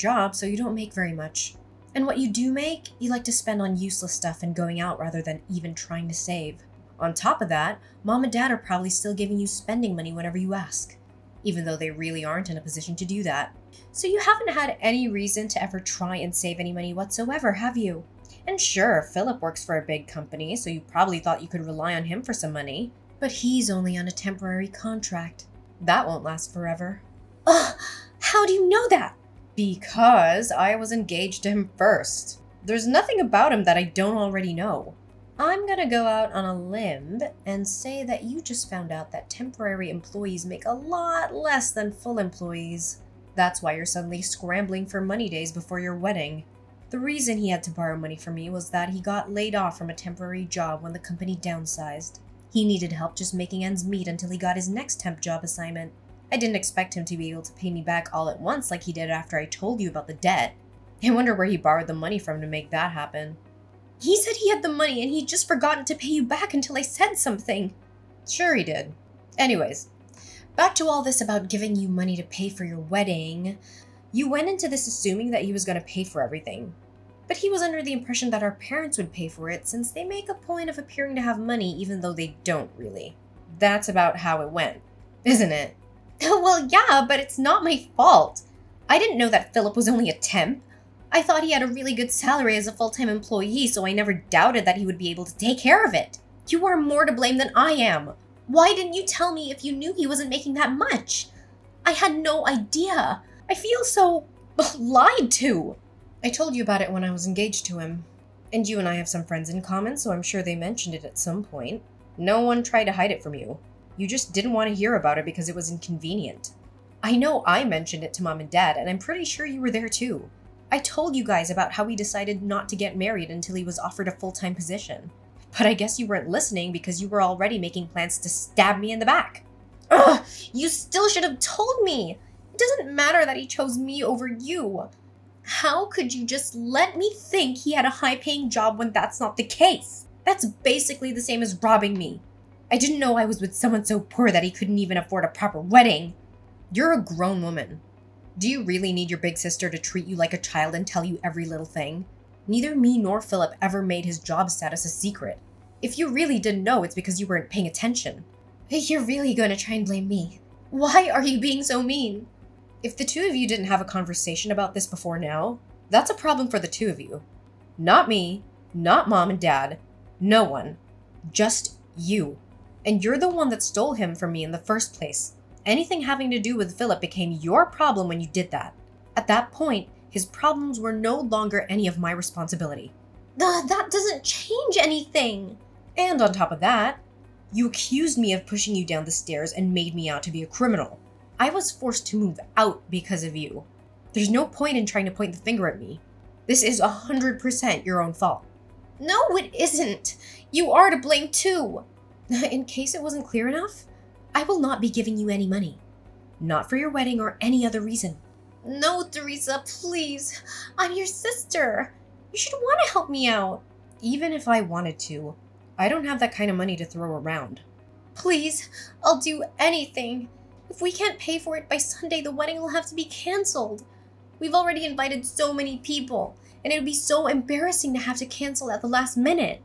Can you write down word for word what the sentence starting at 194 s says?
There's no point in trying to point the finger at me.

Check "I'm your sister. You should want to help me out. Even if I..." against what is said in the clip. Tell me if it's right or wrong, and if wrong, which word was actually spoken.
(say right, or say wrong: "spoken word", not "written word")
right.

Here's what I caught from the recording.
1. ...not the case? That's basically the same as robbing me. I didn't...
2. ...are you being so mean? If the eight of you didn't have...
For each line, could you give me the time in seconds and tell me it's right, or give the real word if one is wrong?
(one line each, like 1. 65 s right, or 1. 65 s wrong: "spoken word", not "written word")
1. 139 s right
2. 161 s wrong: "two", not "eight".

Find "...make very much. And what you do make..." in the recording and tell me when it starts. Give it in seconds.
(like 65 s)
0 s.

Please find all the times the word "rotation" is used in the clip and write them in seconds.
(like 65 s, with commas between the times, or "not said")
not said.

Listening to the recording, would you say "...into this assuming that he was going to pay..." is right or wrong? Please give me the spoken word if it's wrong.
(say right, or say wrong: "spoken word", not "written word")
right.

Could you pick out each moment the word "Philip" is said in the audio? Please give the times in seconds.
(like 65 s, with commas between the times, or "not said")
19 s, 89 s, 153 s, 176 s.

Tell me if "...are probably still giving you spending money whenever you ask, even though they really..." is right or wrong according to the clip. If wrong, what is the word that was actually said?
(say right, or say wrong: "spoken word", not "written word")
right.